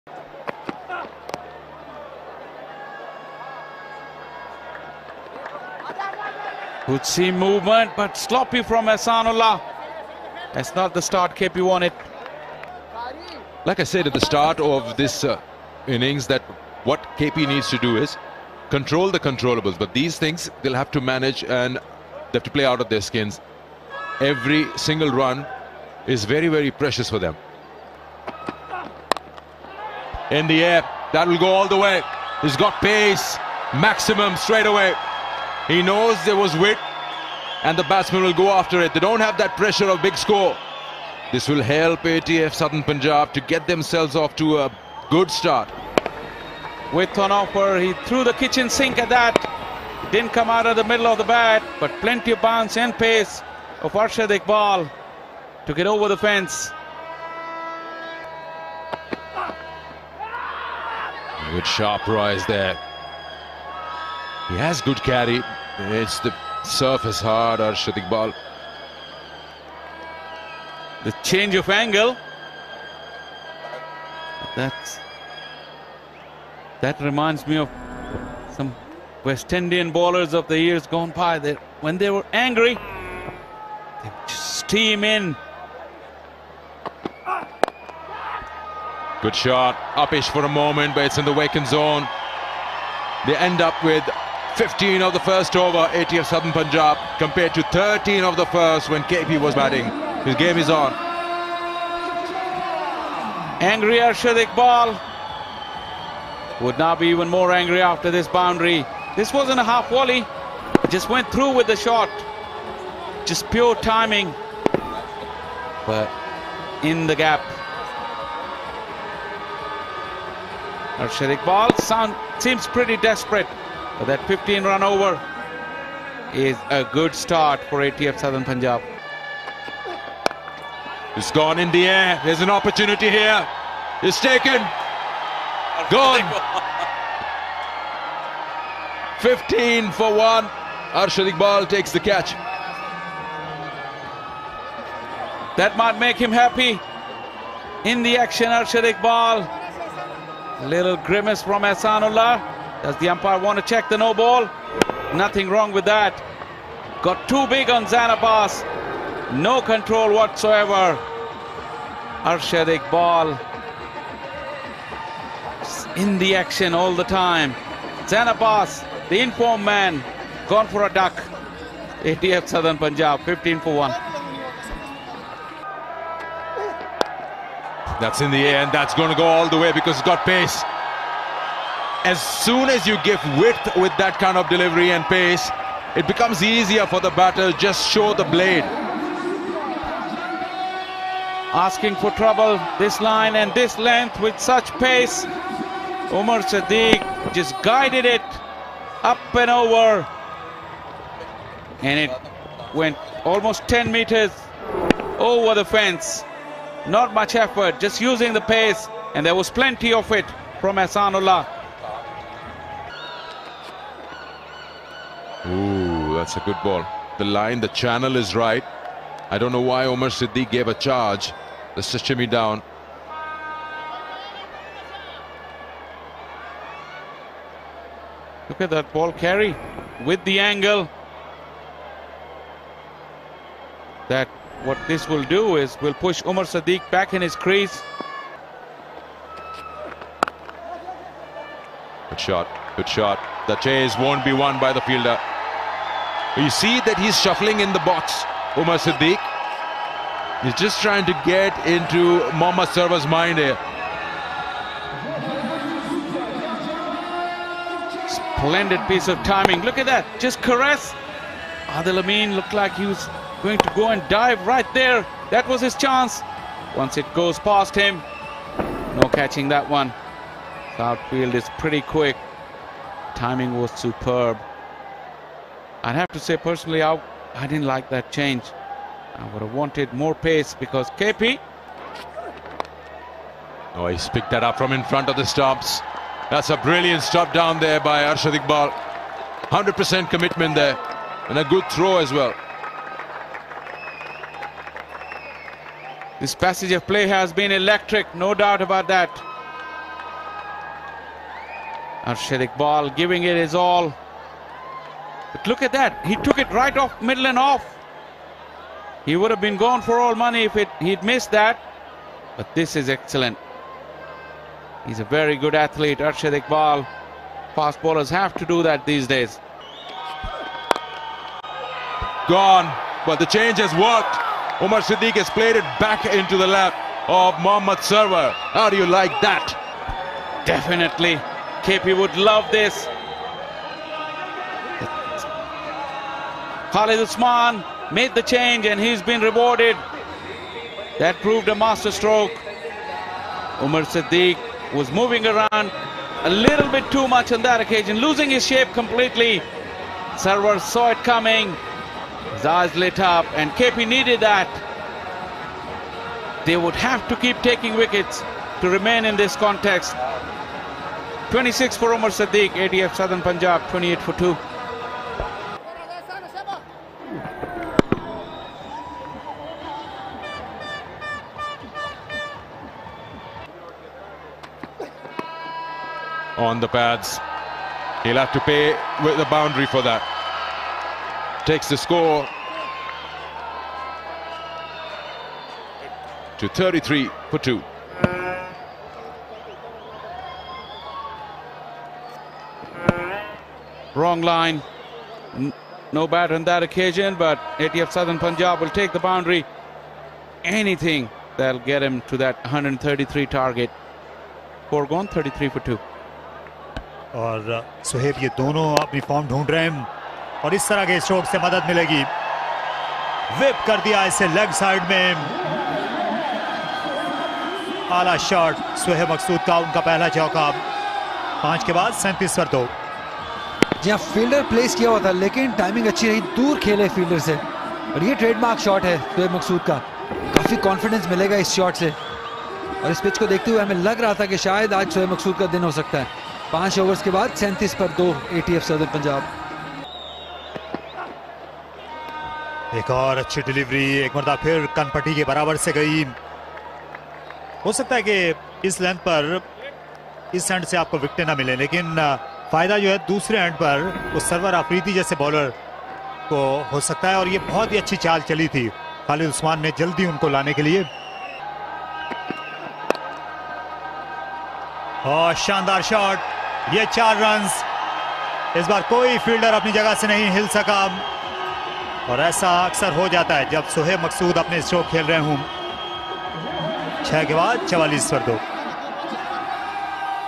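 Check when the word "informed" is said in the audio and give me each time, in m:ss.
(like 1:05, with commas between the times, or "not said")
2:49.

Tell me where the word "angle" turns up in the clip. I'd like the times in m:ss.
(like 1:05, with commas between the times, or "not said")
1:11, 3:50.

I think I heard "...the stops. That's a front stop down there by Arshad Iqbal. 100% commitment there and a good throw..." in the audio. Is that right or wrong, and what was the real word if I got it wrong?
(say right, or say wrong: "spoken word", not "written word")
wrong: "brilliant", not "front".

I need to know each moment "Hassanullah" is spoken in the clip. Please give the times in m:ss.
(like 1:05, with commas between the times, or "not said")
2:31, 3:30.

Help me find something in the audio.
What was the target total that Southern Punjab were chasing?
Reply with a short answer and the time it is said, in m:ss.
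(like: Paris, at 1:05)
133, at 6:42.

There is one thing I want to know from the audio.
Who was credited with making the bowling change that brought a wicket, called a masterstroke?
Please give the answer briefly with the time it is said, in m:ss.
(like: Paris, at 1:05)
Khalid Usman, at 5:36.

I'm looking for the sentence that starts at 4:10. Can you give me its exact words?
He's just trying to get into Mohammad Sarwar's mind here.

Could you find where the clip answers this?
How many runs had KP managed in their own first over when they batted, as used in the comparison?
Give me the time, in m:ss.
1:37.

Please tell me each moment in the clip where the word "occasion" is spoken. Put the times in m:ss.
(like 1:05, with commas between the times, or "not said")
5:47, 6:36.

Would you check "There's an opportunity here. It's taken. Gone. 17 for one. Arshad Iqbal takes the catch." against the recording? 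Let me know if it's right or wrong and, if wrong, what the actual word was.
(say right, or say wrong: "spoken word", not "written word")
wrong: "15", not "17".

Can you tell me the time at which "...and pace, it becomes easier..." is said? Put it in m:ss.
3:04.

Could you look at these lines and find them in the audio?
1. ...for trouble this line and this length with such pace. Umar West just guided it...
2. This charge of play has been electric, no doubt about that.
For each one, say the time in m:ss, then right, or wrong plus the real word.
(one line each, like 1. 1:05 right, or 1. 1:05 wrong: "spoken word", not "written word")
1. 3:11 wrong: "Siddiq", not "West"
2. 4:56 wrong: "passage", not "charge".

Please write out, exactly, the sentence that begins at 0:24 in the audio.
Every single run is very, very precious for them.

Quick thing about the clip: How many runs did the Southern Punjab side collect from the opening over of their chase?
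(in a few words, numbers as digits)
15.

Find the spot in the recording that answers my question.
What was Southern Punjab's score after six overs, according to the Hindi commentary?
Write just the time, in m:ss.
7:57.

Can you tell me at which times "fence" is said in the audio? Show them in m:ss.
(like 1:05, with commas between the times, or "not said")
0:56, 3:25.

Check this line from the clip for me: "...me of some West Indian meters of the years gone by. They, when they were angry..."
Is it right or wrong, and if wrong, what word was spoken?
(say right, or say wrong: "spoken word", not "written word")
wrong: "bowlers", not "meters".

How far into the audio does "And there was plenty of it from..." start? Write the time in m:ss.
3:29.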